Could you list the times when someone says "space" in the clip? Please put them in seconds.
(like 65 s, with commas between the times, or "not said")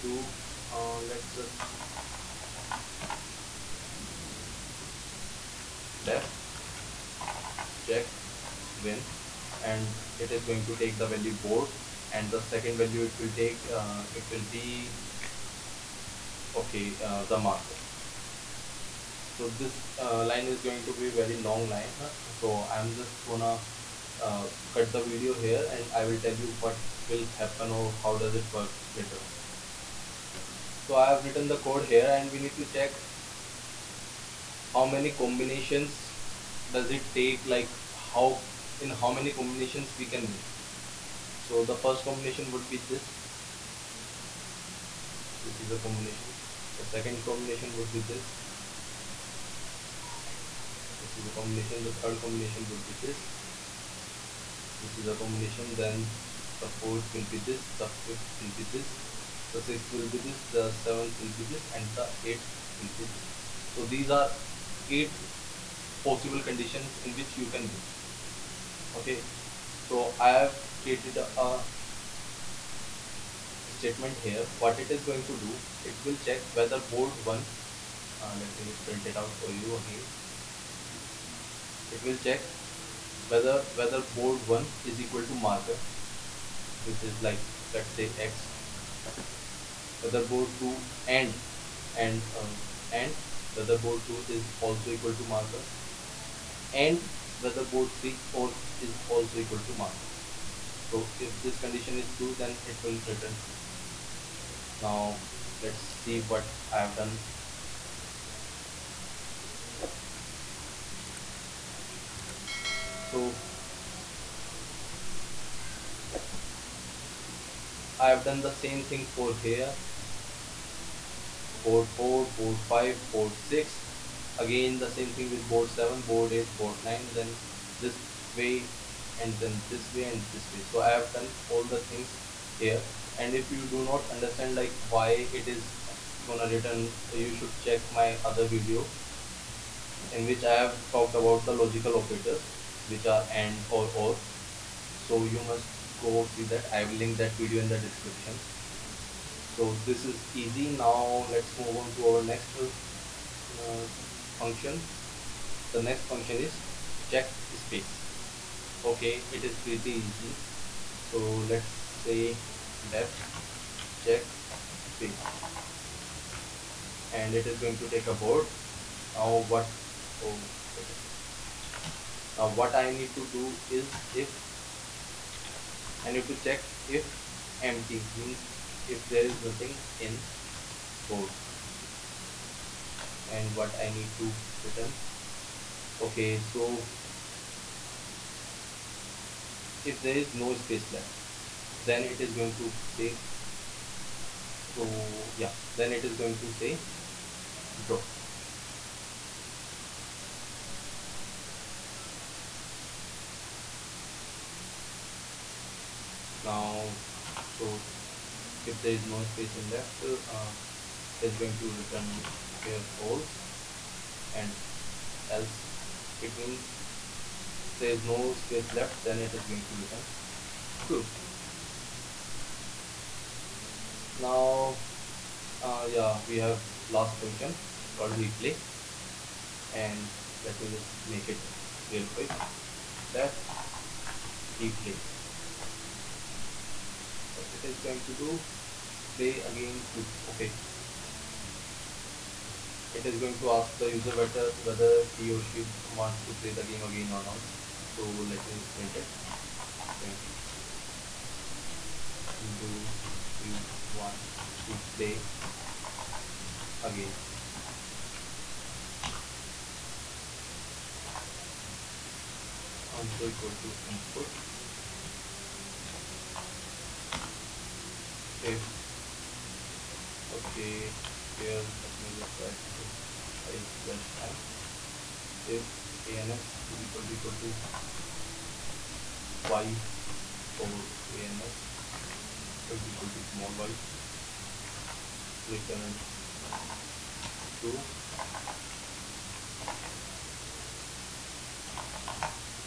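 157 s, 164 s, 190 s, 209 s, 218 s.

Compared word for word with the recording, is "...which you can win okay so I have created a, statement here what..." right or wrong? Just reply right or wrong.
right.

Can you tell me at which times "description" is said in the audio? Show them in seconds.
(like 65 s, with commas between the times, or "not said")
147 s.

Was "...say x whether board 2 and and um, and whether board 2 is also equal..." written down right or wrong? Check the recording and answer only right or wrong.
right.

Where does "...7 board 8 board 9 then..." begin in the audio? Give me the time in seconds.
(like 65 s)
125 s.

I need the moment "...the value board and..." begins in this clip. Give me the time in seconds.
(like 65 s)
11 s.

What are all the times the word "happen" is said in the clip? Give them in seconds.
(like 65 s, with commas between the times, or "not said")
27 s.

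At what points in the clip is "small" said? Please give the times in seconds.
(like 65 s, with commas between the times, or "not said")
283 s.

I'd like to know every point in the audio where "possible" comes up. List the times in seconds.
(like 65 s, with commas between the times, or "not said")
66 s.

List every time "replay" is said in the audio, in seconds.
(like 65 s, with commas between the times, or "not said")
228 s, 234 s.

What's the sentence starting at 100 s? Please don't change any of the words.
So if this condition is true then it will return true.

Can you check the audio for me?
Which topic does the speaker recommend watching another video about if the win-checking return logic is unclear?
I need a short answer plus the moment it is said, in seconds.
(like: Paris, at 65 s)
logical operators, at 141 s.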